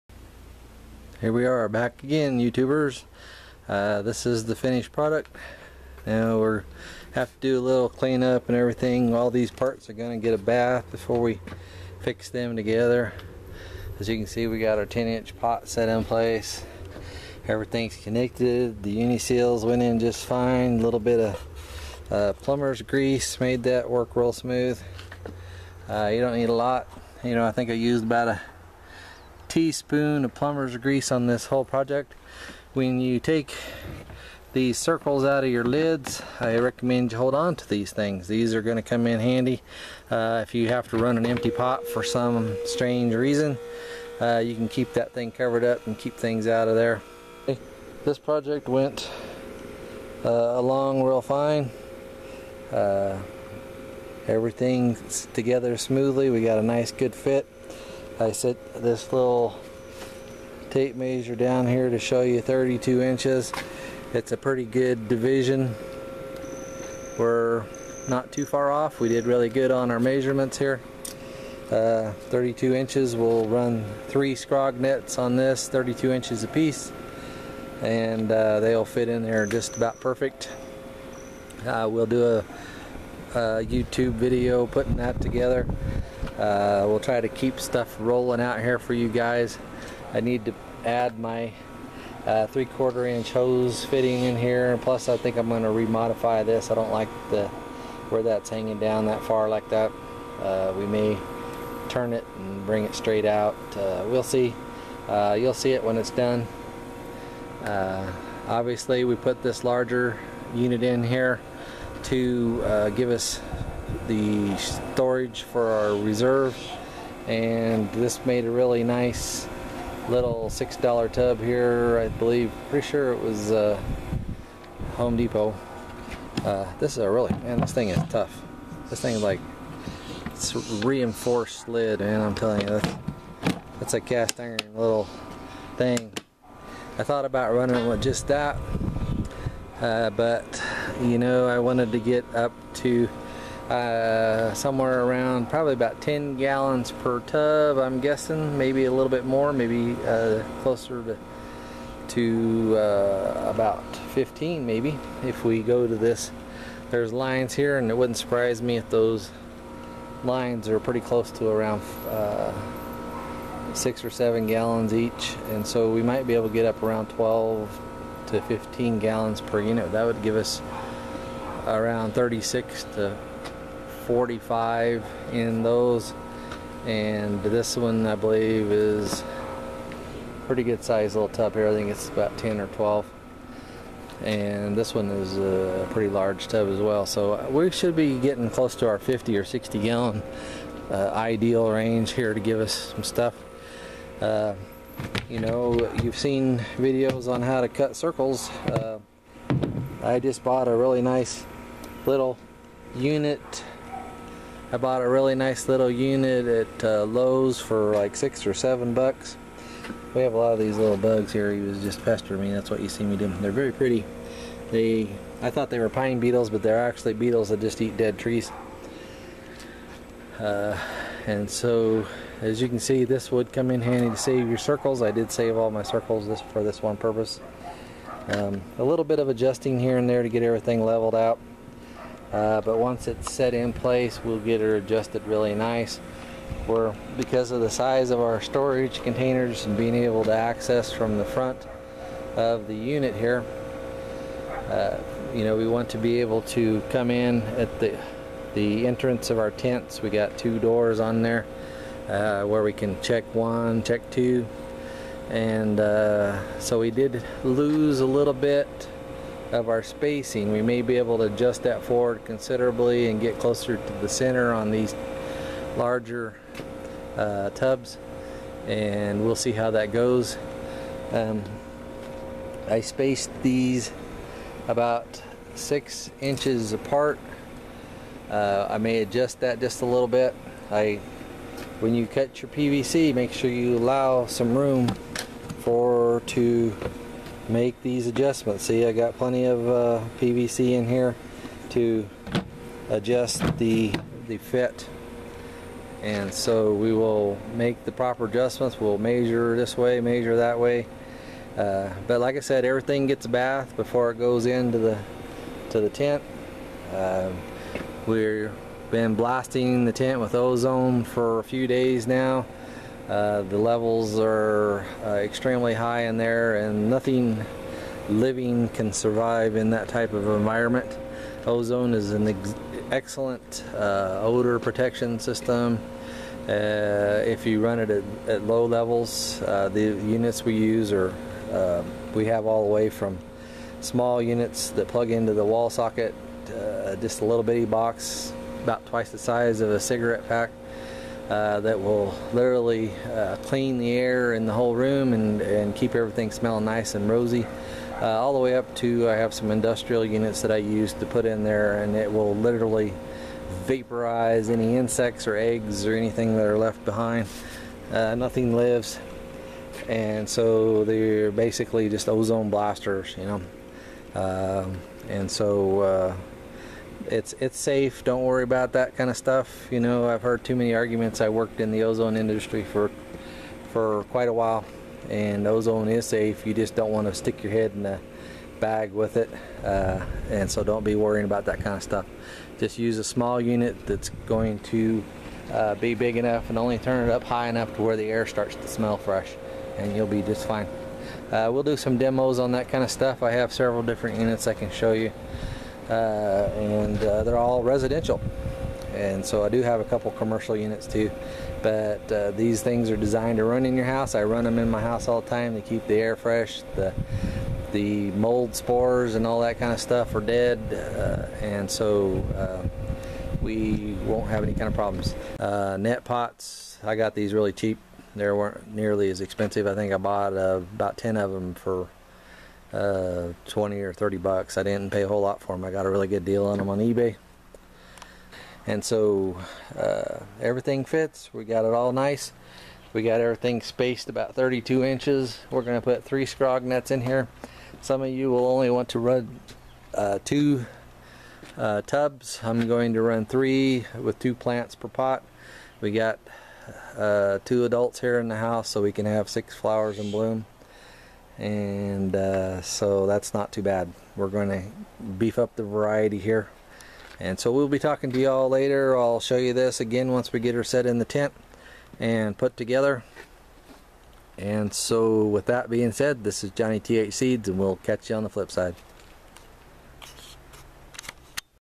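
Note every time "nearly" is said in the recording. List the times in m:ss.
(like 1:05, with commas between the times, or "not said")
6:58.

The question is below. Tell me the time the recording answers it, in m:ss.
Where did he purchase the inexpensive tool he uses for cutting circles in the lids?
3:27.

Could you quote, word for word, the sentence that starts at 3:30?
We have a lot of these little bugs here.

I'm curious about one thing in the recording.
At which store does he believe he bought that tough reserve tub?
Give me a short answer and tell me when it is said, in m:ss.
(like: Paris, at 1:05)
Home Depot, at 2:04.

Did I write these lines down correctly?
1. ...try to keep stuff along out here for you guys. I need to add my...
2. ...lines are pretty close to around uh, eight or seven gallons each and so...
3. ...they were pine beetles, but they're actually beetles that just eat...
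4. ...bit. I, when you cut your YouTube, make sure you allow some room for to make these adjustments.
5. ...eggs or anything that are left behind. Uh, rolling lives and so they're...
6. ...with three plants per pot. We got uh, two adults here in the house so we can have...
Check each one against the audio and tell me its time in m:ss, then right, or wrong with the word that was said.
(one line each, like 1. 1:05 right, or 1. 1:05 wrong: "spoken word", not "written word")
1. 1:26 wrong: "rolling", not "along"
2. 2:40 wrong: "six", not "eight"
3. 3:35 right
4. 4:40 wrong: "PVC", not "YouTube"
5. 5:55 wrong: "nothing", not "rolling"
6. 7:23 wrong: "two", not "three".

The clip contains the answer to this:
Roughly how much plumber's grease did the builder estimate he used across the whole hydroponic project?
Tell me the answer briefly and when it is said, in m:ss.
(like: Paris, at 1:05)
a teaspoon, at 0:28.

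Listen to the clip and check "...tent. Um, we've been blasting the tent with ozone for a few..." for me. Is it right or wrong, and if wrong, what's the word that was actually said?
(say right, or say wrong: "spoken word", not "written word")
right.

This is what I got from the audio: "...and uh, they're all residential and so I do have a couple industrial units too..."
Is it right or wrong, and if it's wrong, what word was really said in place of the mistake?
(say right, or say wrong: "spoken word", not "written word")
wrong: "commercial", not "industrial".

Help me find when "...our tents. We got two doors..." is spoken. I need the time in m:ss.
4:09.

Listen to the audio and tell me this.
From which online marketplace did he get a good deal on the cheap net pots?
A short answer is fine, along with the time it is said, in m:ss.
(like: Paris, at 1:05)
eBay, at 7:06.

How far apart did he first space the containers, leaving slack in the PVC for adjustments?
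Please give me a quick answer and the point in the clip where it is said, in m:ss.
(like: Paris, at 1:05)
6 inches, at 4:35.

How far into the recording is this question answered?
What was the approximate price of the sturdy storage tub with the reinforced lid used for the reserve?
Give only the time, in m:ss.
2:00.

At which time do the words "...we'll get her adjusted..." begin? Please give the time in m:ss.
3:54.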